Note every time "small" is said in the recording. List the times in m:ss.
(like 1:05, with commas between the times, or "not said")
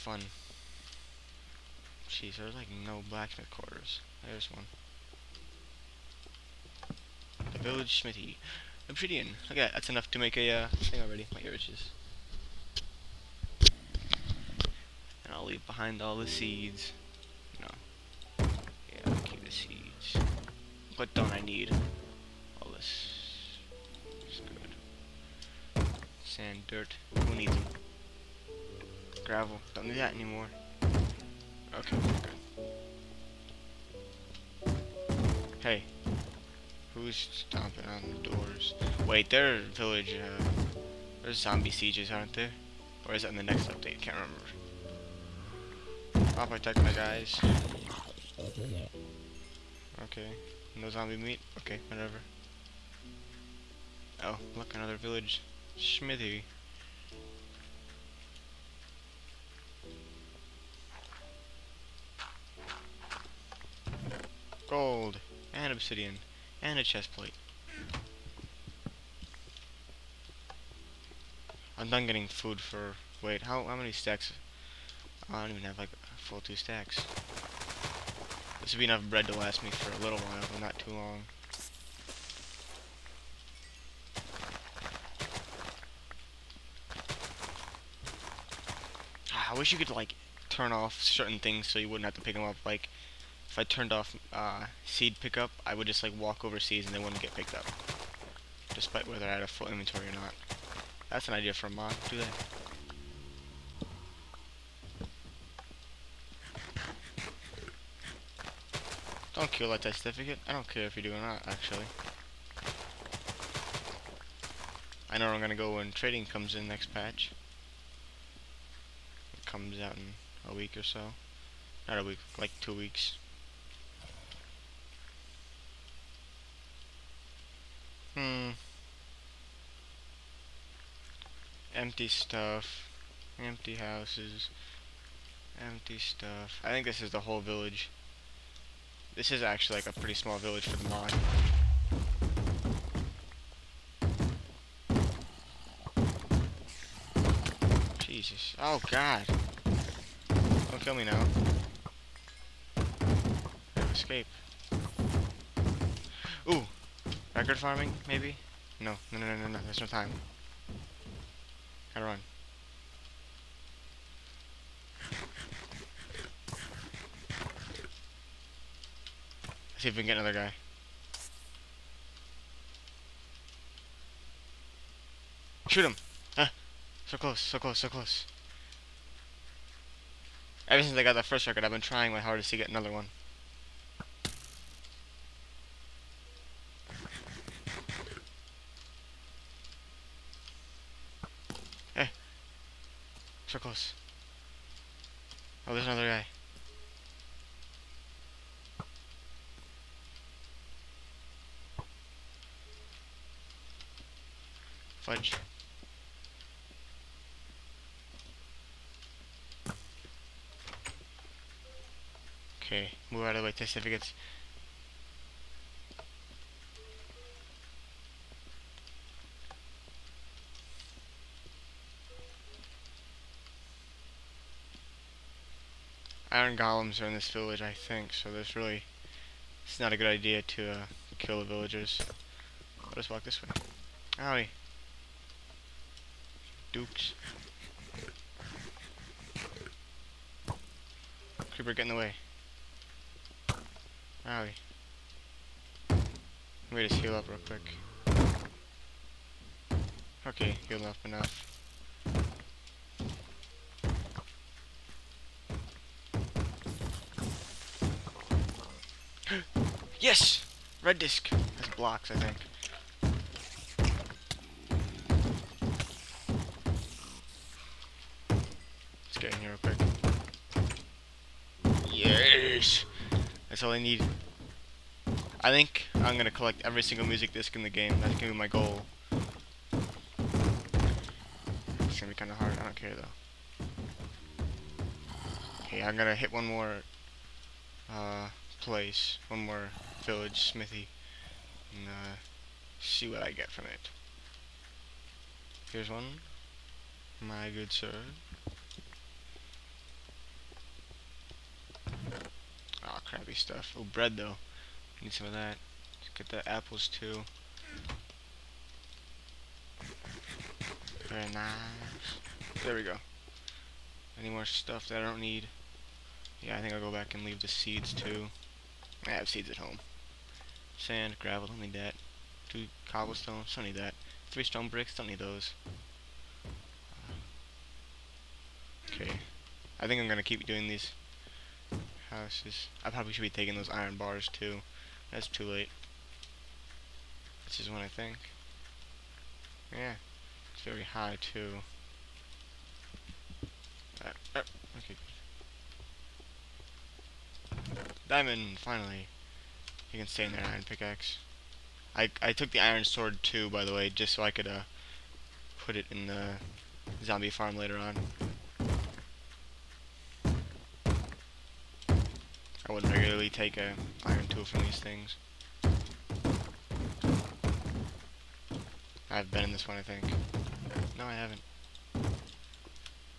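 2:20.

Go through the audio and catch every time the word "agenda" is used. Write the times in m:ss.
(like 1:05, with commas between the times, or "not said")
not said.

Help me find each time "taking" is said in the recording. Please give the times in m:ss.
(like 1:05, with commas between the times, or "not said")
5:33.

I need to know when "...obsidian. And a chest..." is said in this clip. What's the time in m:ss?
1:05.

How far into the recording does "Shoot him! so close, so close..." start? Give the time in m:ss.
2:55.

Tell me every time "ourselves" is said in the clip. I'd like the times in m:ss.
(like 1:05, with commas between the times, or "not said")
not said.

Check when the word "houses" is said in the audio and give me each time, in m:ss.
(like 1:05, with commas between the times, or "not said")
2:13, 5:32.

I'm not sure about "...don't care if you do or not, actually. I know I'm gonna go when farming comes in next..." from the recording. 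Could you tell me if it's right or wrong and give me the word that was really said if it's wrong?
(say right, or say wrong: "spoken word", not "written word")
wrong: "trading", not "farming".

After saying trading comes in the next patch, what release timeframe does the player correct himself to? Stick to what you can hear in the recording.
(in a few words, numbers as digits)
two weeks.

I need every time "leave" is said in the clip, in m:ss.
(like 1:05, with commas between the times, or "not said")
0:15, 5:17.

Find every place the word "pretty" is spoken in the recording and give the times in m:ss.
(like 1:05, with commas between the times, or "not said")
2:19.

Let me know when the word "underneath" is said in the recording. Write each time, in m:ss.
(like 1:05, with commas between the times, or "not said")
not said.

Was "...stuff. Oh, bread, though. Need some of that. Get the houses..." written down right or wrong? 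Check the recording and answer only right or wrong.
wrong.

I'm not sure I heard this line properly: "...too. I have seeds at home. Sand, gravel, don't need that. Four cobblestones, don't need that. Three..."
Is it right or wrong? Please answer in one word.
wrong.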